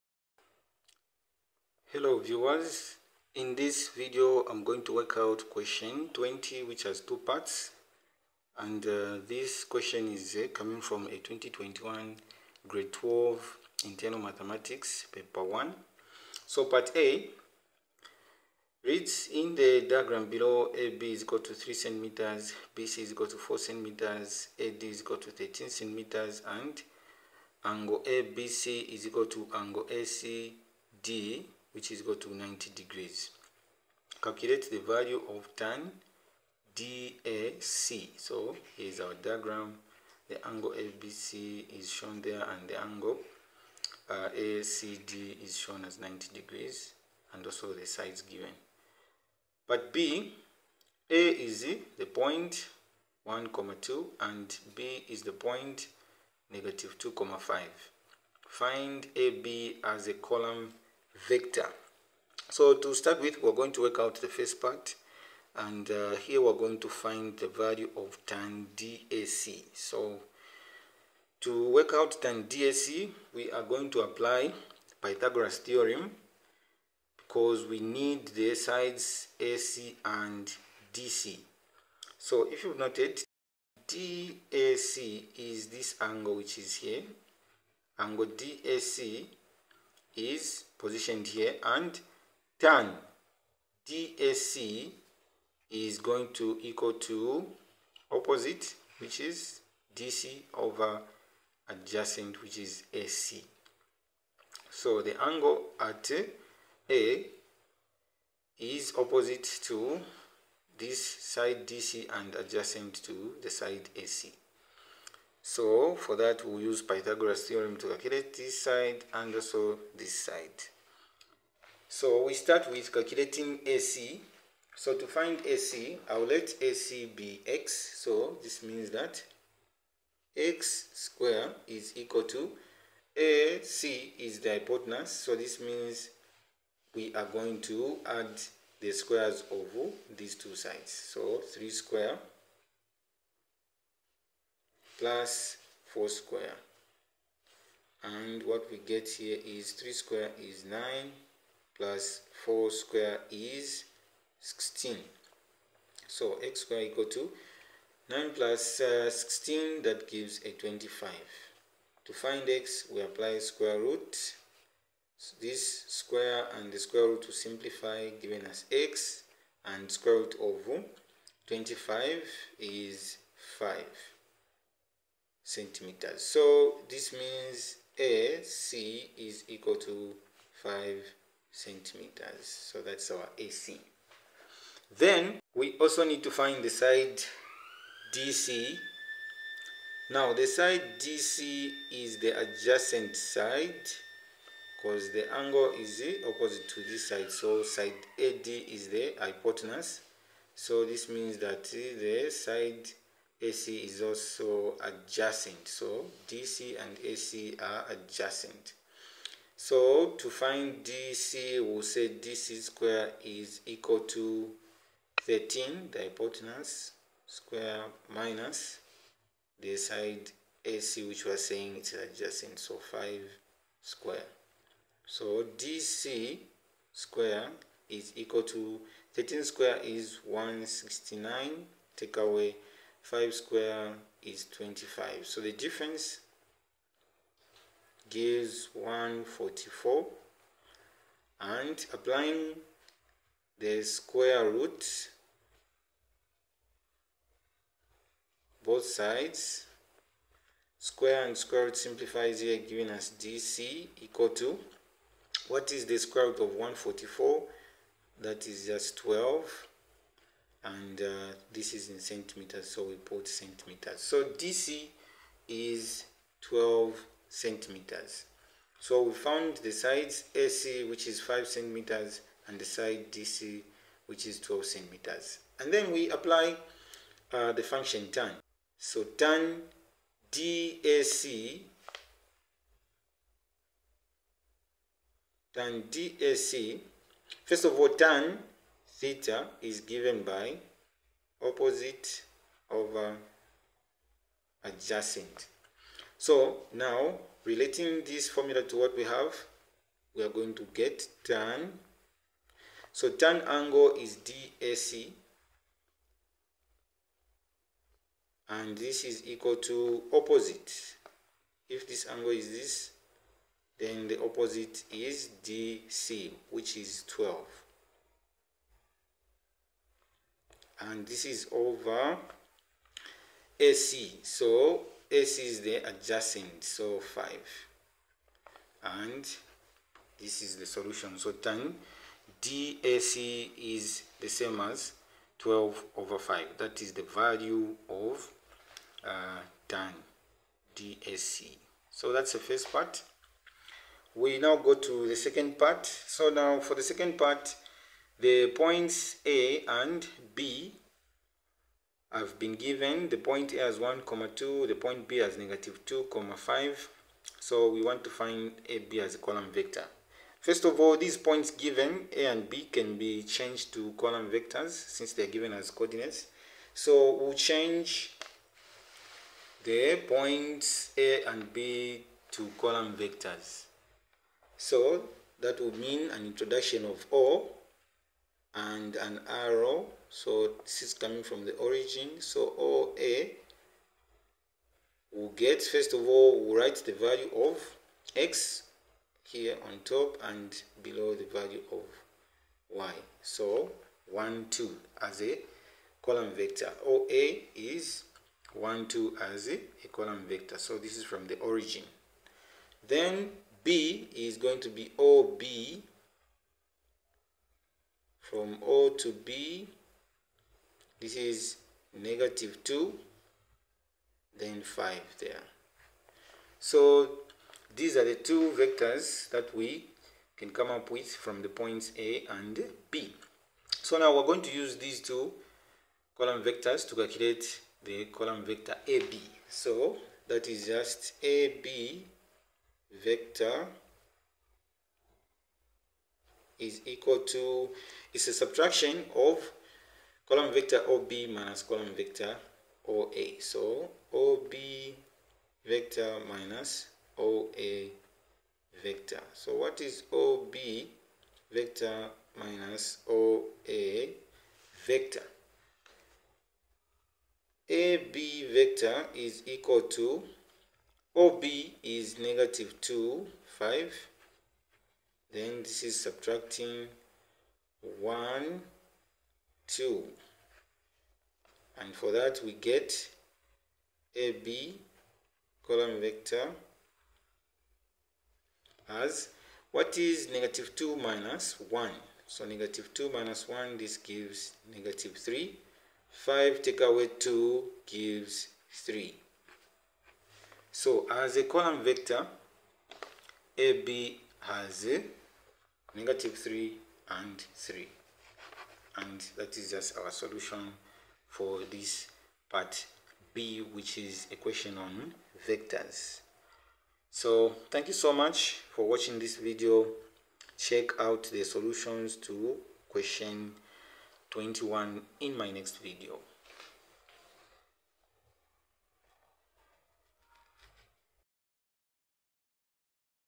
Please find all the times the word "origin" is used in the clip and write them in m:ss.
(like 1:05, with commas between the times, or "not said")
6:21, 6:41.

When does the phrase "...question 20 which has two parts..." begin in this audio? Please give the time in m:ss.
0:05.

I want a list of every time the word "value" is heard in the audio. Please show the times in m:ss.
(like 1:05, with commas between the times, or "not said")
0:34, 1:07, 5:37, 6:26, 6:31.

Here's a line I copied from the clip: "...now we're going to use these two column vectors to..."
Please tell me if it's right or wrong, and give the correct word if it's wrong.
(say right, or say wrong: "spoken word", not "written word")
right.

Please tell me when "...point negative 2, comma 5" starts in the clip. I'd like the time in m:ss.
0:55.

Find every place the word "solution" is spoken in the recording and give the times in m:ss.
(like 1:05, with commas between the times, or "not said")
5:30, 8:20, 8:31.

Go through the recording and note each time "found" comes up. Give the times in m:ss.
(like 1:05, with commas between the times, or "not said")
4:29.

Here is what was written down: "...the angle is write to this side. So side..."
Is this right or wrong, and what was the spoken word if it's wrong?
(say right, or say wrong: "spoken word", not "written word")
wrong: "opposite", not "write".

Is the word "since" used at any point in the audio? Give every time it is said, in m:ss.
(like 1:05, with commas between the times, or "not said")
6:04.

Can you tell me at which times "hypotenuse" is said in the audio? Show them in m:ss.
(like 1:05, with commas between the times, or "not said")
2:14, 3:19, 3:36.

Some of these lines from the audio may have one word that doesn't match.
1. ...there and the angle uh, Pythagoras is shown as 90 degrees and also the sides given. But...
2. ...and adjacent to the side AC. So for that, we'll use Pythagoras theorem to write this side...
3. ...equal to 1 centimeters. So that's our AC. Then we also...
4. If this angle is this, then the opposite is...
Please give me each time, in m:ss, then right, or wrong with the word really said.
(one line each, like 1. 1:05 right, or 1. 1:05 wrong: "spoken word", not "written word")
1. 0:42 wrong: "ACD", not "Pythagoras"
2. 1:52 wrong: "calculate", not "write"
3. 2:59 wrong: "5", not "1"
4. 5:11 right.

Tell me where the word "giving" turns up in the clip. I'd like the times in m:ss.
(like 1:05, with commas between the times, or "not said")
2:48, 4:12.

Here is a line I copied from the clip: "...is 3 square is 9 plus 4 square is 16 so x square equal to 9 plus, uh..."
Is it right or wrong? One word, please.
right.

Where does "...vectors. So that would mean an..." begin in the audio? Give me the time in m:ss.
6:12.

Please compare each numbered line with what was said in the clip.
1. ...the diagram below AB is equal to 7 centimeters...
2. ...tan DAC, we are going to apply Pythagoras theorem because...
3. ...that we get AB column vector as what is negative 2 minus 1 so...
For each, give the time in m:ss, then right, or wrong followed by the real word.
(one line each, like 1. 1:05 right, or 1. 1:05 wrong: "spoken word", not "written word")
1. 0:19 wrong: "3", not "7"
2. 1:12 right
3. 7:52 right.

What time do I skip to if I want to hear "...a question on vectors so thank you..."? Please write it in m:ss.
8:24.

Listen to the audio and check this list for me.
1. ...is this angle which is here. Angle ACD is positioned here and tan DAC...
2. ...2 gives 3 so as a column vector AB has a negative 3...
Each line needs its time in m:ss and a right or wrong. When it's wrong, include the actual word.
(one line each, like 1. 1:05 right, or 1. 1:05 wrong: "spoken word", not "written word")
1. 1:25 wrong: "DAC", not "ACD"
2. 8:07 right.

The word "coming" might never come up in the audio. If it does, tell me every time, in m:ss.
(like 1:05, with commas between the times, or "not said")
0:10, 6:20.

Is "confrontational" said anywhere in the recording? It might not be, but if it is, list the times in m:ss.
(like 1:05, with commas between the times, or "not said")
not said.